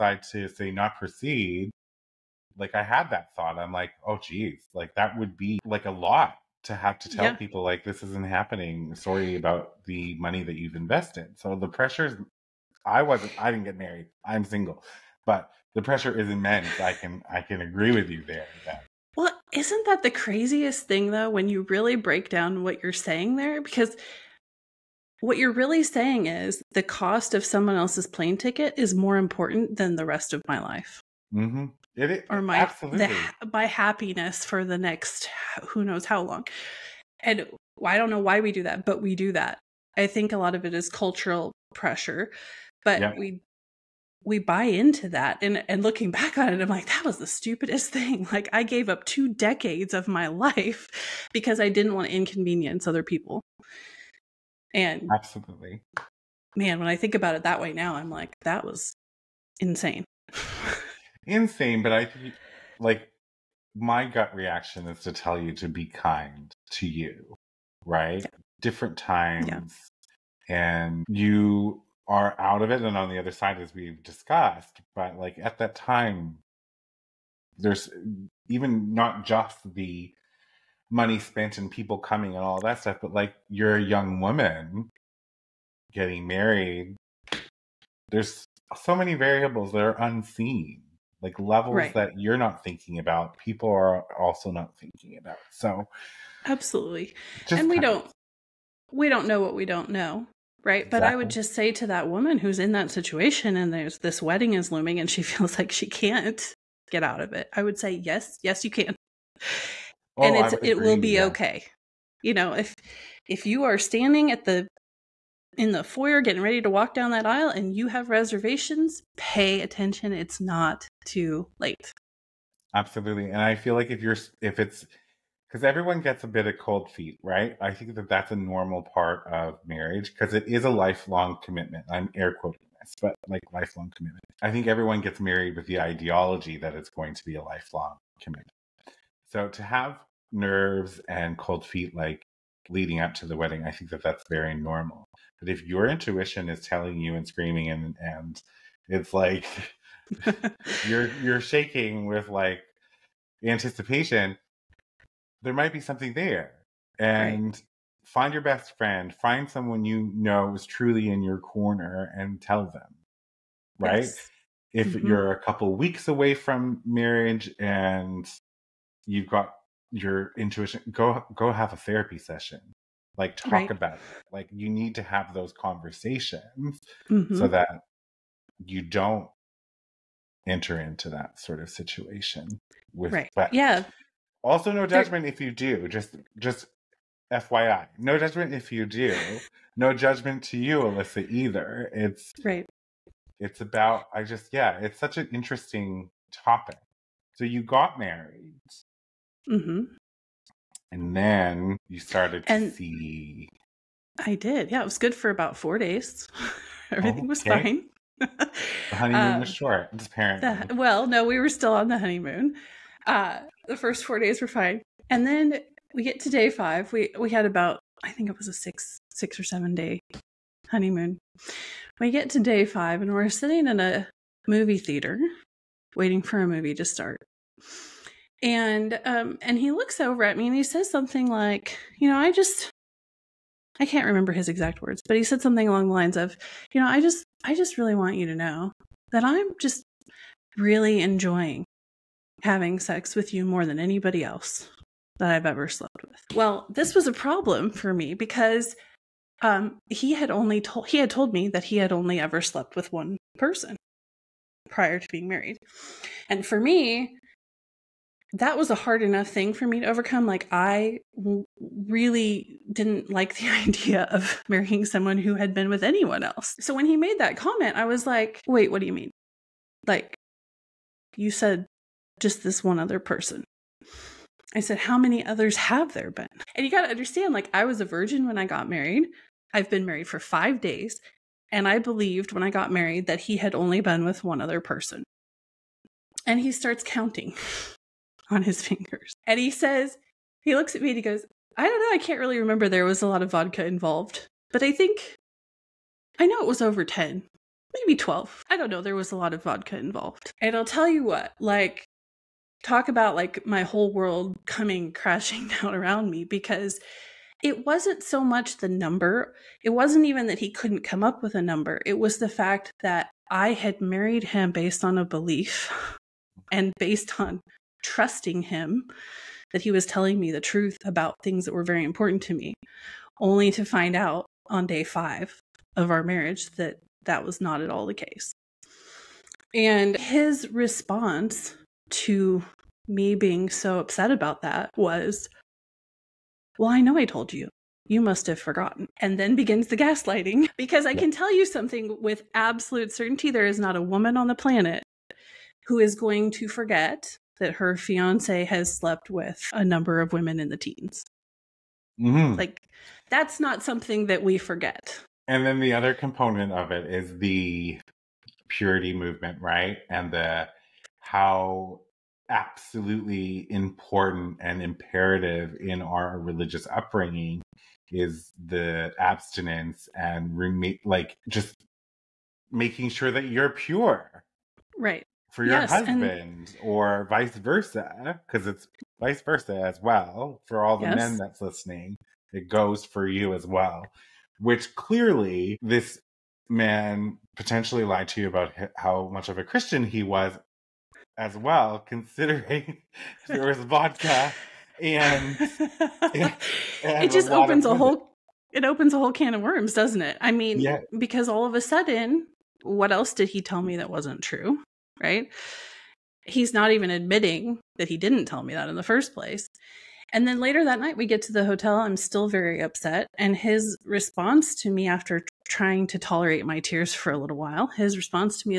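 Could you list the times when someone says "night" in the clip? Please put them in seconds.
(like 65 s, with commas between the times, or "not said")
410 s.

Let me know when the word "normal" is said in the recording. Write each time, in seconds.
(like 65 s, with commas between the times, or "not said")
128 s, 144 s.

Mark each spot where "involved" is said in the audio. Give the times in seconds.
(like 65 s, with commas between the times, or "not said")
293 s, 299 s.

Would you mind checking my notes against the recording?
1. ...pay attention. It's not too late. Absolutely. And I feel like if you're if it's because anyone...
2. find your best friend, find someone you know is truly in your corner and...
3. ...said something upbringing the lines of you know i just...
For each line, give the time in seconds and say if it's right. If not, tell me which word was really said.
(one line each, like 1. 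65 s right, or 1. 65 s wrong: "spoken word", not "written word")
1. 119 s wrong: "everyone", not "anyone"
2. 158 s right
3. 235 s wrong: "along", not "upbringing".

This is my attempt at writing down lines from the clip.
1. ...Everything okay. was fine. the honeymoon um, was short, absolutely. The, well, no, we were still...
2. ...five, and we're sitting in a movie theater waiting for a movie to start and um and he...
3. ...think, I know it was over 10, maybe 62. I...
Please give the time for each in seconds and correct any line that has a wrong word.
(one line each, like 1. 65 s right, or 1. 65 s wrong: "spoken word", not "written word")
1. 206 s wrong: "apparently", not "absolutely"
2. 222 s right
3. 294 s wrong: "12", not "62".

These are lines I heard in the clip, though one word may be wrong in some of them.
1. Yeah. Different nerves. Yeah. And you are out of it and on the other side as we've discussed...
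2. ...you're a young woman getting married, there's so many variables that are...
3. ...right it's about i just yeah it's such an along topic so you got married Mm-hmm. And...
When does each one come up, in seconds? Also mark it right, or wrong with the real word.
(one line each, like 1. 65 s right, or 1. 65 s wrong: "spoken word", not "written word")
1. 68 s wrong: "times", not "nerves"
2. 83 s right
3. 192 s wrong: "interesting", not "along".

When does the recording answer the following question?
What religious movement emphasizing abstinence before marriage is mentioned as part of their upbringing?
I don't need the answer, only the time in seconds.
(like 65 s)
358 s.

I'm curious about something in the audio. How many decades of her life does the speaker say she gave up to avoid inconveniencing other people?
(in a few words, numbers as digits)
2.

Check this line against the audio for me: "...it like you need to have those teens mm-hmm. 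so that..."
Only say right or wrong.
wrong.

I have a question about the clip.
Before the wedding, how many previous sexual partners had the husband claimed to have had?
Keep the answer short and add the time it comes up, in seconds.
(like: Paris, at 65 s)
1, at 252 s.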